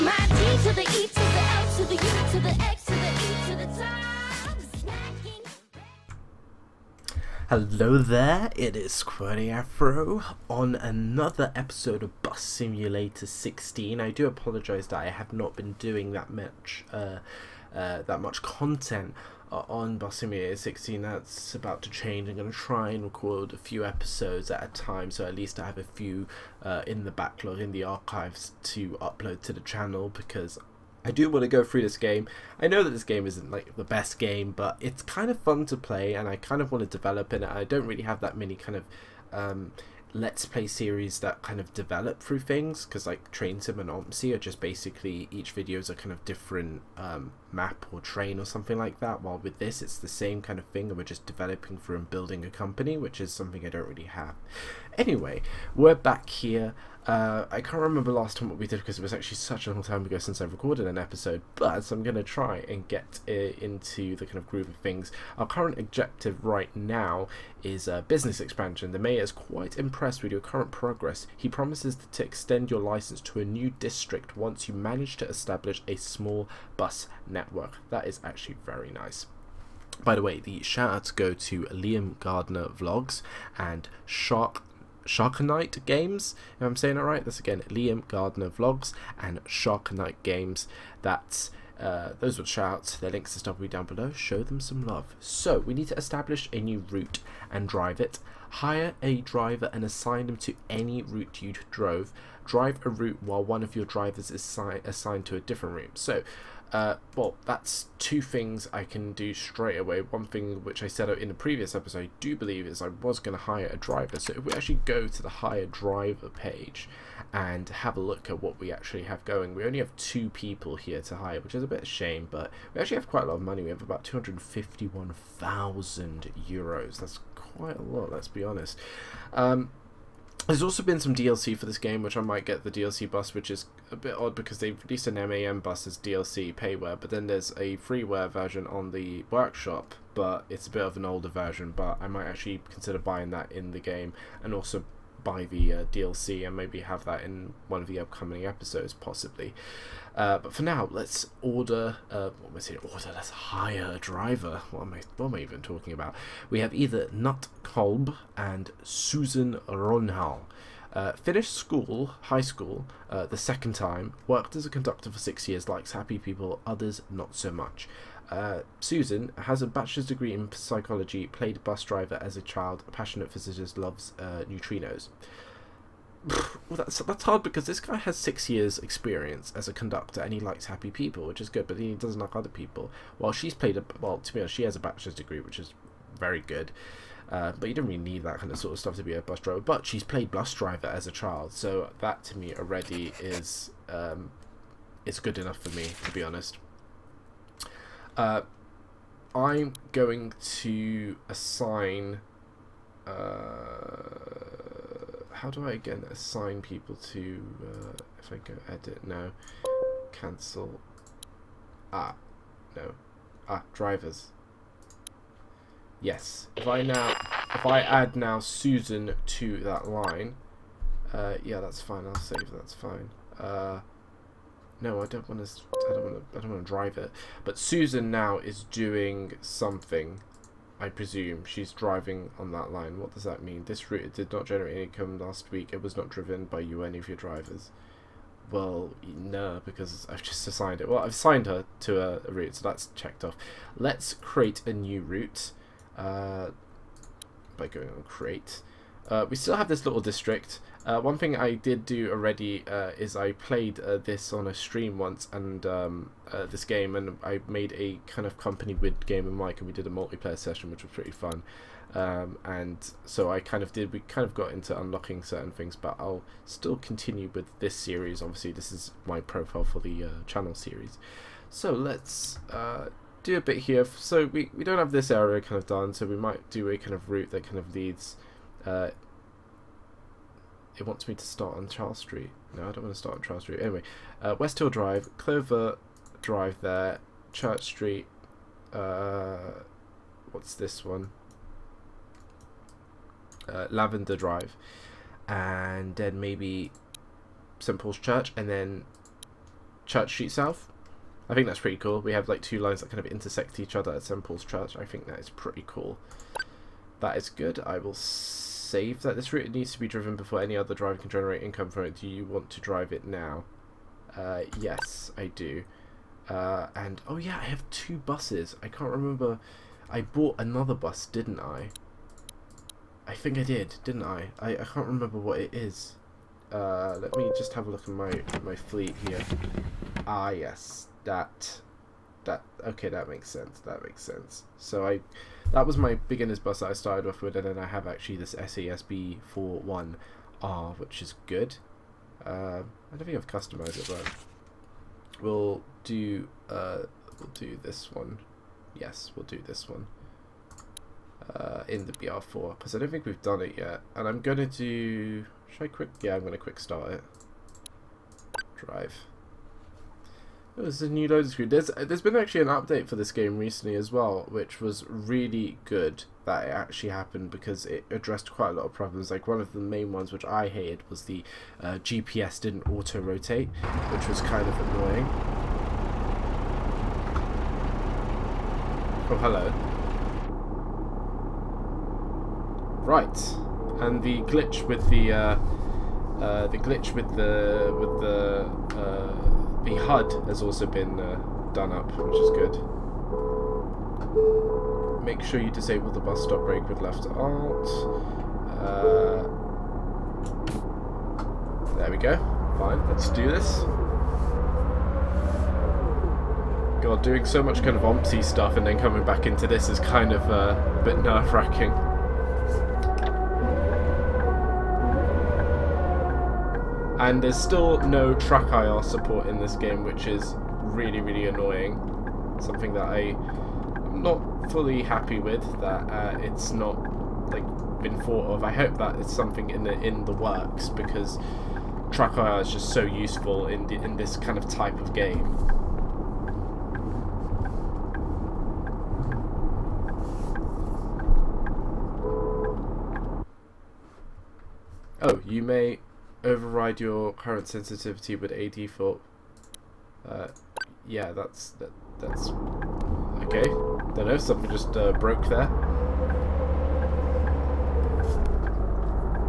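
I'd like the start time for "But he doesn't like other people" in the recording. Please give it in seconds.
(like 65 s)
181 s.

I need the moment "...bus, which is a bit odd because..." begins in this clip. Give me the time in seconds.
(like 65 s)
133 s.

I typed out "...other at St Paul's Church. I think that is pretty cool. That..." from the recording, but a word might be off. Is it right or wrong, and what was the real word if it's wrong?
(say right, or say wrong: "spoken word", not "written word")
right.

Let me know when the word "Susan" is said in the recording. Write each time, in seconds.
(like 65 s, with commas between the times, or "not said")
158 s, 168 s, 218 s, 227 s.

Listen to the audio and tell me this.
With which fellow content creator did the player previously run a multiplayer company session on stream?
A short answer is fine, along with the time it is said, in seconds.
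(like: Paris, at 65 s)
Gamer Mike, at 259 s.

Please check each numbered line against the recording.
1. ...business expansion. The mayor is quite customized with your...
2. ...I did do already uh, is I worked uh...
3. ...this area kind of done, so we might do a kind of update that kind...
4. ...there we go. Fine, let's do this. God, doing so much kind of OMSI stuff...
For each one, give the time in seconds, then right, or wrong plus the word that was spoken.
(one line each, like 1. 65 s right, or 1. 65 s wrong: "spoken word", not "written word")
1. 68 s wrong: "impressed", not "customized"
2. 251 s wrong: "played", not "worked"
3. 274 s wrong: "route", not "update"
4. 401 s right.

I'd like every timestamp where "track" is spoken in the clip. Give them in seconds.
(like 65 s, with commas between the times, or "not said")
418 s, 431 s.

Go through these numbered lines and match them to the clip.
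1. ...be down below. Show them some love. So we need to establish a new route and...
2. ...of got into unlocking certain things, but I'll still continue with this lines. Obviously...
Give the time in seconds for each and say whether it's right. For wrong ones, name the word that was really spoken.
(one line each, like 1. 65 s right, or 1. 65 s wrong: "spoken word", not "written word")
1. 93 s right
2. 264 s wrong: "series", not "lines".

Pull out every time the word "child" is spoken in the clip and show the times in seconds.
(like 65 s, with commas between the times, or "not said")
172 s, 191 s.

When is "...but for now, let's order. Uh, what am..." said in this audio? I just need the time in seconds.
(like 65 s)
150 s.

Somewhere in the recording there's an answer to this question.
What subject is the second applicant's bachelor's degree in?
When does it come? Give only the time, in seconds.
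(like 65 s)
170 s.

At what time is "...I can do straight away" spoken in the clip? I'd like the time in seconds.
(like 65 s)
108 s.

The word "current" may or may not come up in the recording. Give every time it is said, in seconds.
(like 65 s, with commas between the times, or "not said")
65 s, 70 s, 447 s.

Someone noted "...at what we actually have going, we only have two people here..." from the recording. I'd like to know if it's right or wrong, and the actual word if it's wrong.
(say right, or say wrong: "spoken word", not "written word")
right.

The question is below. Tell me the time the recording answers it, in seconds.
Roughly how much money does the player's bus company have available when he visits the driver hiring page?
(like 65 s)
124 s.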